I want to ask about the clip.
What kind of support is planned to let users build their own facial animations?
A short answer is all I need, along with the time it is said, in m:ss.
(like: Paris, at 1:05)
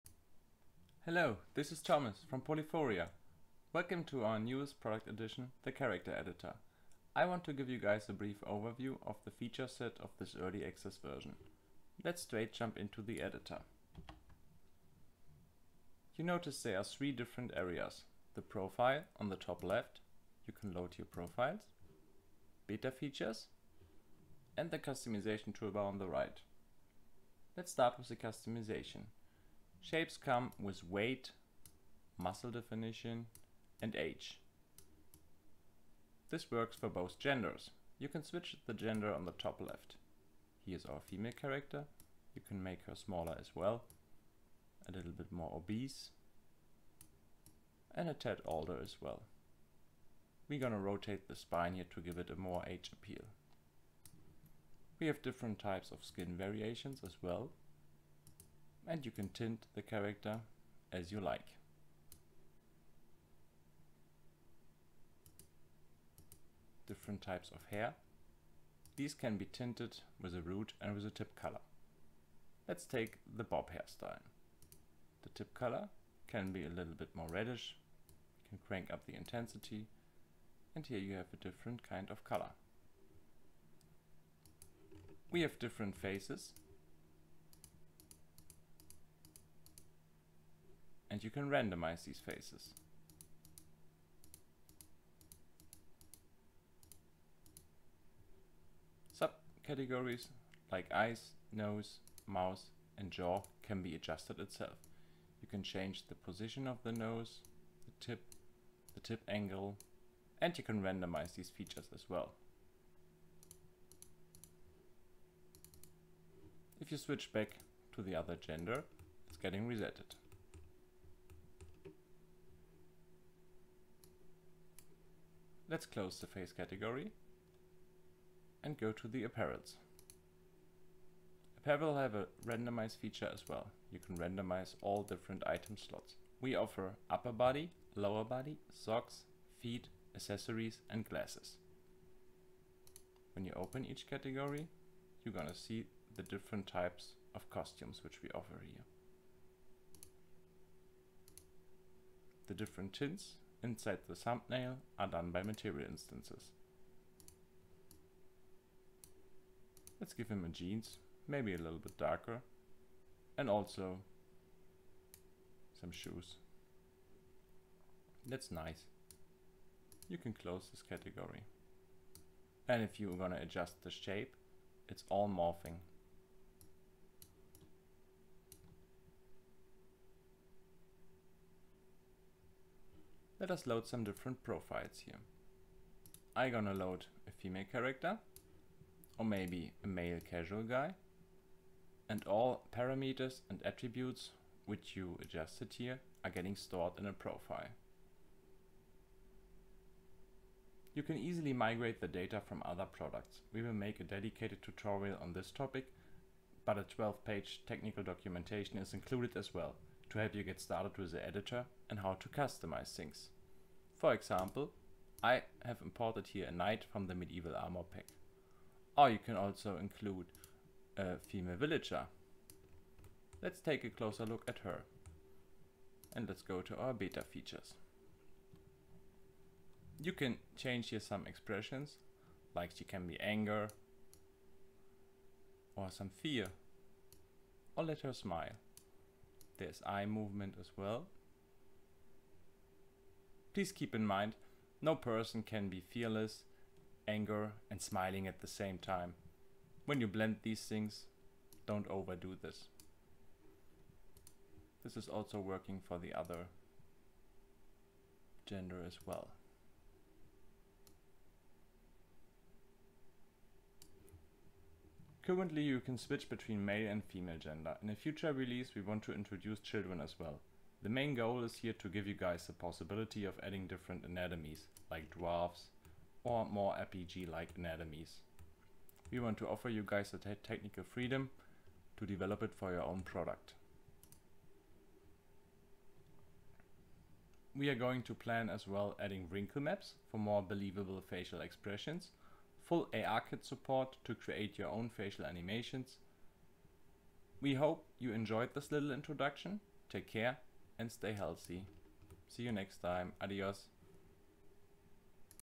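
full ARKit support, at 4:52.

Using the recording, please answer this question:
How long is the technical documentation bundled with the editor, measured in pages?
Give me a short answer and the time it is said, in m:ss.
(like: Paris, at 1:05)
12 pages, at 3:27.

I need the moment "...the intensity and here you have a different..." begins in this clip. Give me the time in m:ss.
1:19.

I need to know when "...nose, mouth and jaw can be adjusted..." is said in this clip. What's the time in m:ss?
1:41.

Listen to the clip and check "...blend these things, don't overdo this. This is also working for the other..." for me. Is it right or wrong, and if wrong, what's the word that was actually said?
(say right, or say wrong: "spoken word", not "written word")
right.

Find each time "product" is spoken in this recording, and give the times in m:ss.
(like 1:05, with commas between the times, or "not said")
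0:04, 3:22, 4:43.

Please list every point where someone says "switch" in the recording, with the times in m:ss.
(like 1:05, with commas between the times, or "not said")
0:38, 1:56, 4:25.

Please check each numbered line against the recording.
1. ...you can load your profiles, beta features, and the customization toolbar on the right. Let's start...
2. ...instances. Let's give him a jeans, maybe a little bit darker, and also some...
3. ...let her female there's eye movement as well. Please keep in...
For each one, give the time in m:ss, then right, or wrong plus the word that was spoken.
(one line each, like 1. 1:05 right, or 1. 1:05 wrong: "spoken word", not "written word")
1. 0:20 right
2. 2:35 right
3. 3:57 wrong: "smile", not "female".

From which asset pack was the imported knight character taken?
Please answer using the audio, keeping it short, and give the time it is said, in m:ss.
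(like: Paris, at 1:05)
medieval armor pack, at 3:37.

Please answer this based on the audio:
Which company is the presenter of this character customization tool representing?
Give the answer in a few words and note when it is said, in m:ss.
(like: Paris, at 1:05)
Polyphoria, at 0:02.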